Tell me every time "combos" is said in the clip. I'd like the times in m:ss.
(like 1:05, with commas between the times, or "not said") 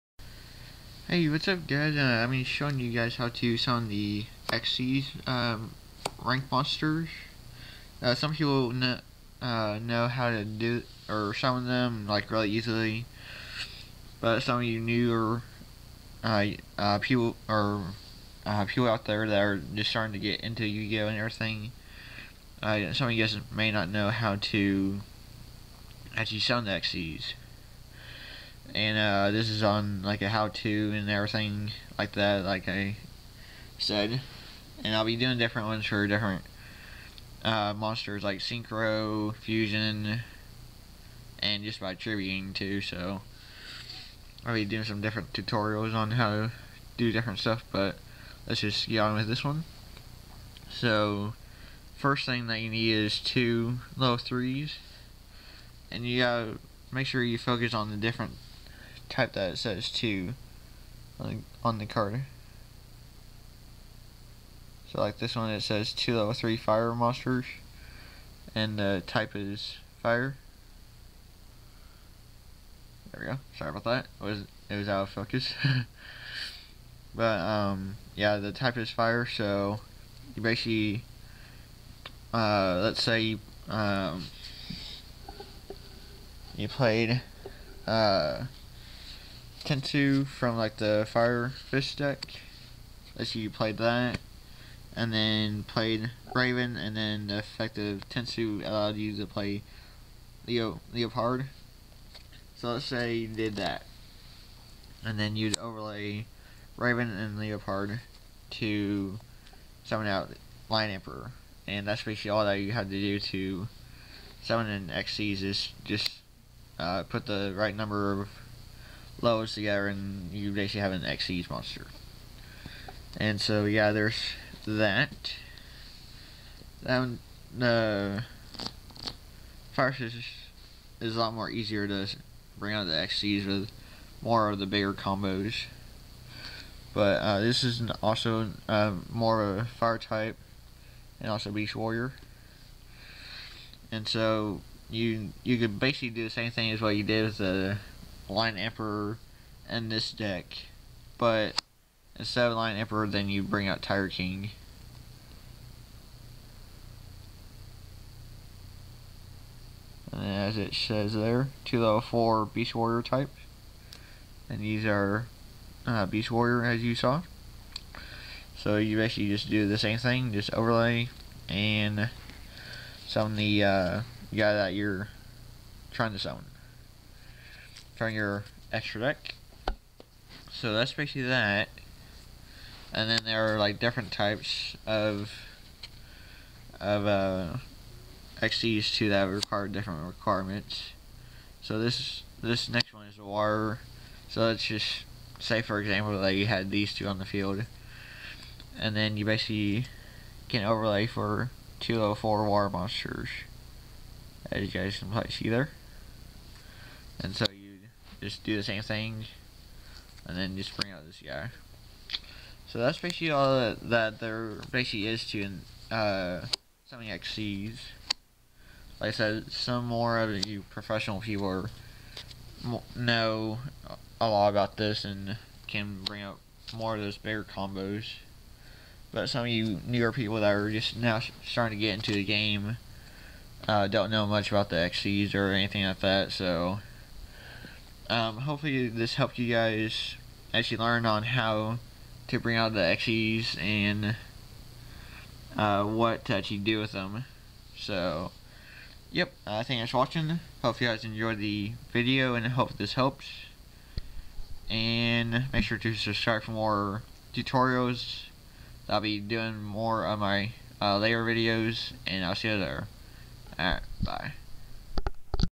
2:14, 3:47.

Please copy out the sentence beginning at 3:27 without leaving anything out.
And so just do the same thing and then just bring out this guy.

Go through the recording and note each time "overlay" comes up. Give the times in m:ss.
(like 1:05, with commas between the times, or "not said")
1:45, 2:50, 3:20.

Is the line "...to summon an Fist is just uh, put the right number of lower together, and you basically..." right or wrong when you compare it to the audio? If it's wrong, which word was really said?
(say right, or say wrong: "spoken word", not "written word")
wrong: "Xyz", not "Fist".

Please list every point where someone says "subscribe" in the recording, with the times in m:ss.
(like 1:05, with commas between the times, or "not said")
4:15.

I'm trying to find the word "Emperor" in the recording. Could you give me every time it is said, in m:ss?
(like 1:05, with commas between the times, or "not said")
1:50, 2:28, 2:32.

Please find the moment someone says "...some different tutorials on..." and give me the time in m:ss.
0:44.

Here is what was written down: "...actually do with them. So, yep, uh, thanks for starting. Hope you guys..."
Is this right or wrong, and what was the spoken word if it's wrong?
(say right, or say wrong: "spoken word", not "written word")
wrong: "watching", not "starting".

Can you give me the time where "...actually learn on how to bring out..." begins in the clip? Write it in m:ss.
4:00.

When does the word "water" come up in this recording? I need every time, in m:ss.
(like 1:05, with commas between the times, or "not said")
3:13, 3:22.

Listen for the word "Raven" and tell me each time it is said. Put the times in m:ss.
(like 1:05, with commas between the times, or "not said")
1:36, 1:46.